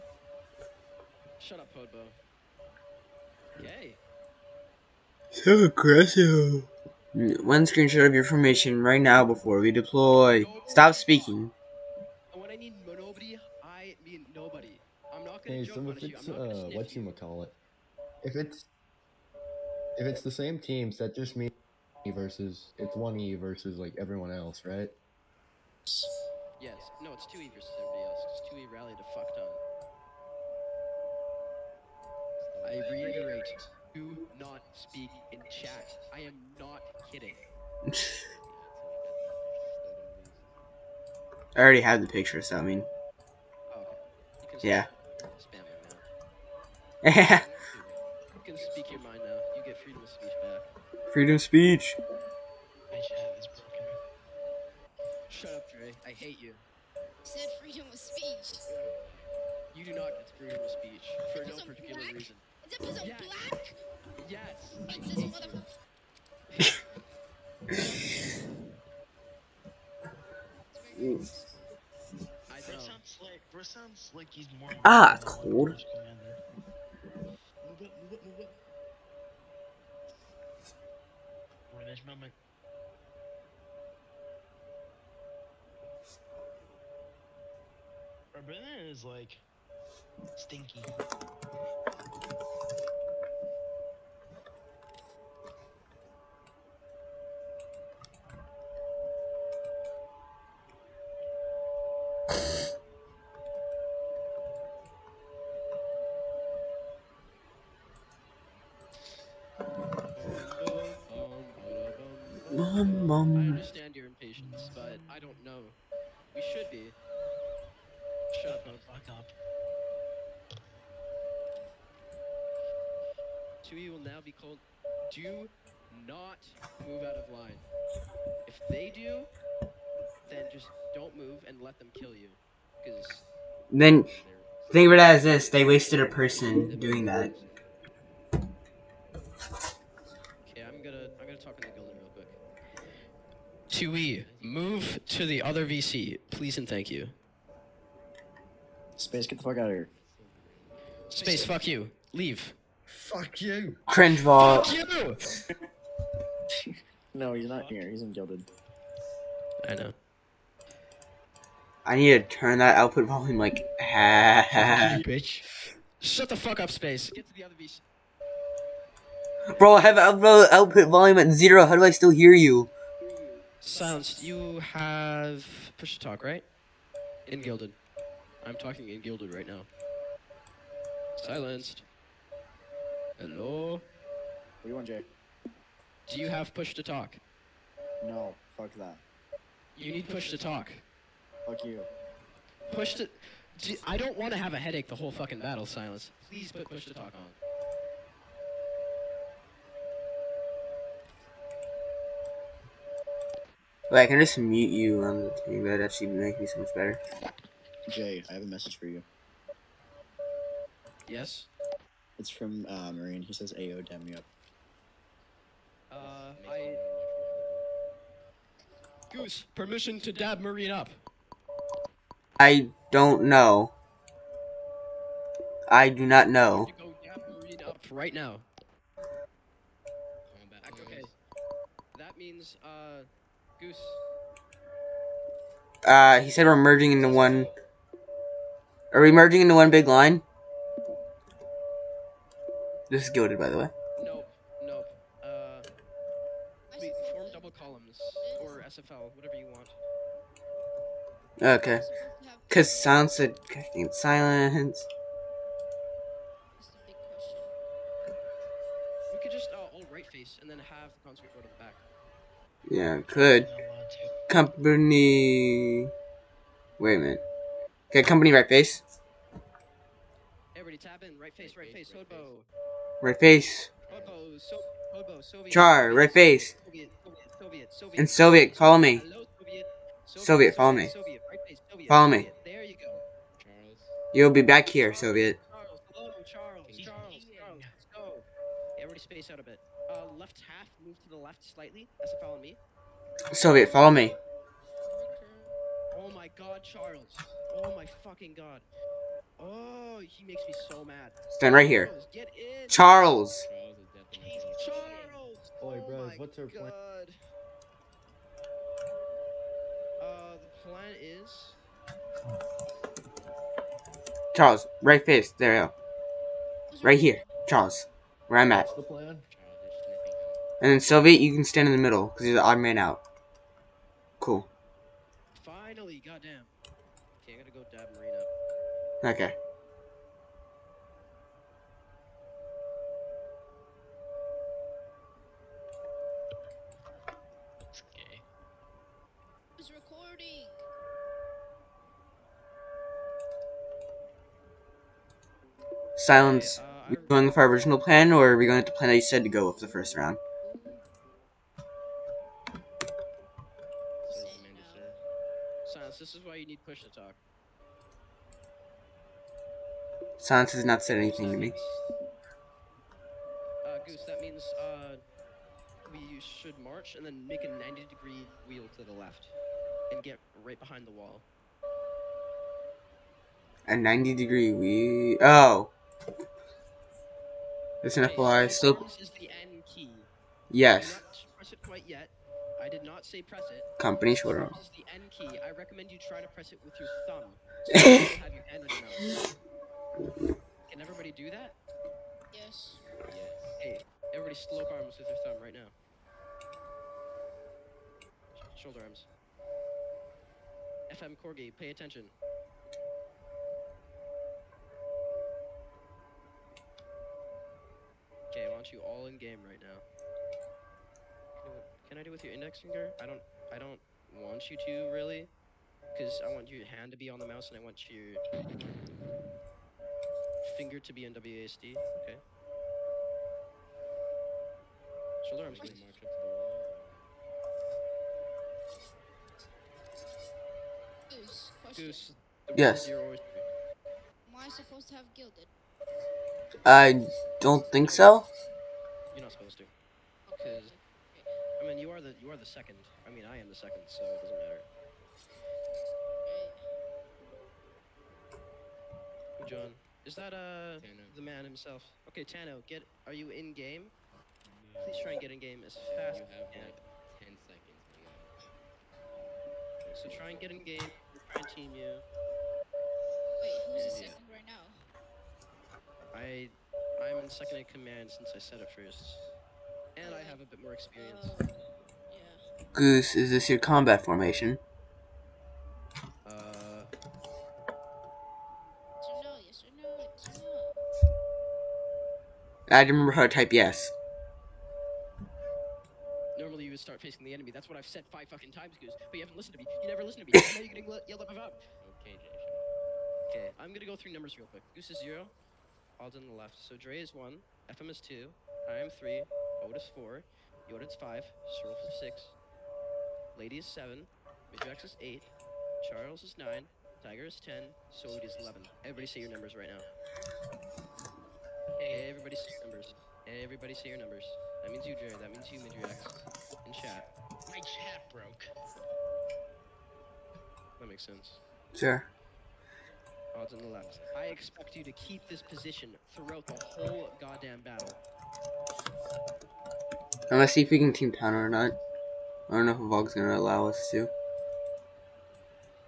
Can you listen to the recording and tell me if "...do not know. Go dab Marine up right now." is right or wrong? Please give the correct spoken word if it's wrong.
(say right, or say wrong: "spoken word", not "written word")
right.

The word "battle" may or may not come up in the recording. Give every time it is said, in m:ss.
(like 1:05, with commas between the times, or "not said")
3:15, 8:47.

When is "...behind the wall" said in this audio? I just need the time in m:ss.
6:10.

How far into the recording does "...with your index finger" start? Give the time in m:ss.
6:52.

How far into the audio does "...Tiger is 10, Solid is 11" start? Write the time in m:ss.
8:27.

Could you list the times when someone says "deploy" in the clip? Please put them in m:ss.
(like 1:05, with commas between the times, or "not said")
0:09.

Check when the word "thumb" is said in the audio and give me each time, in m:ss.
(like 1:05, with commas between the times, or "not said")
6:27, 6:35.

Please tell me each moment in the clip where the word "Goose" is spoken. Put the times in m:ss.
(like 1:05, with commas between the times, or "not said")
3:39, 3:53, 6:03, 7:11, 7:52, 8:08, 8:14.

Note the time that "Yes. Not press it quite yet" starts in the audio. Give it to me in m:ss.
6:20.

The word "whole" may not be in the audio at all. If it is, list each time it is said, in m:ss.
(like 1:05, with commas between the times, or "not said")
3:14, 8:46.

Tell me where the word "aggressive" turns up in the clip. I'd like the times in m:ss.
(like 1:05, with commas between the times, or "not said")
0:05.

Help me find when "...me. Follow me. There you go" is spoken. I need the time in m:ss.
4:40.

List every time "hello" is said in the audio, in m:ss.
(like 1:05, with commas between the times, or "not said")
3:03, 4:45.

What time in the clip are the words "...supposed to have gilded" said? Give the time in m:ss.
7:14.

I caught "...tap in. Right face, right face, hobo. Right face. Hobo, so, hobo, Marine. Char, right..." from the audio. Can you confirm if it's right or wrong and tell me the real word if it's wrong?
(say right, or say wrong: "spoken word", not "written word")
wrong: "Soviet", not "Marine".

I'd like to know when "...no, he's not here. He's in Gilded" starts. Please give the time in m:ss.
2:37.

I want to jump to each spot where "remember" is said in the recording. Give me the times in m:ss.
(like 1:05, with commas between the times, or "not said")
8:02.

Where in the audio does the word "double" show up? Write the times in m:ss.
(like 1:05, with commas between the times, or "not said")
4:07.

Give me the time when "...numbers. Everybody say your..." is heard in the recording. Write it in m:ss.
8:32.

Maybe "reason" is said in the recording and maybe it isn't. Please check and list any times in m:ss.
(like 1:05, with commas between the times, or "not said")
1:02.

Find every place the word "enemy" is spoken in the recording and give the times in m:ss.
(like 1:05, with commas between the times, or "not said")
8:07.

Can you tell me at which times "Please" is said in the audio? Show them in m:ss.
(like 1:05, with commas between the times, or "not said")
2:26, 3:16, 7:34.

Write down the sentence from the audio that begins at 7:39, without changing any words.
Okay, so try and get in game.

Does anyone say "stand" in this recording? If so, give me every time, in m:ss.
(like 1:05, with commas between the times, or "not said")
5:01, 5:21.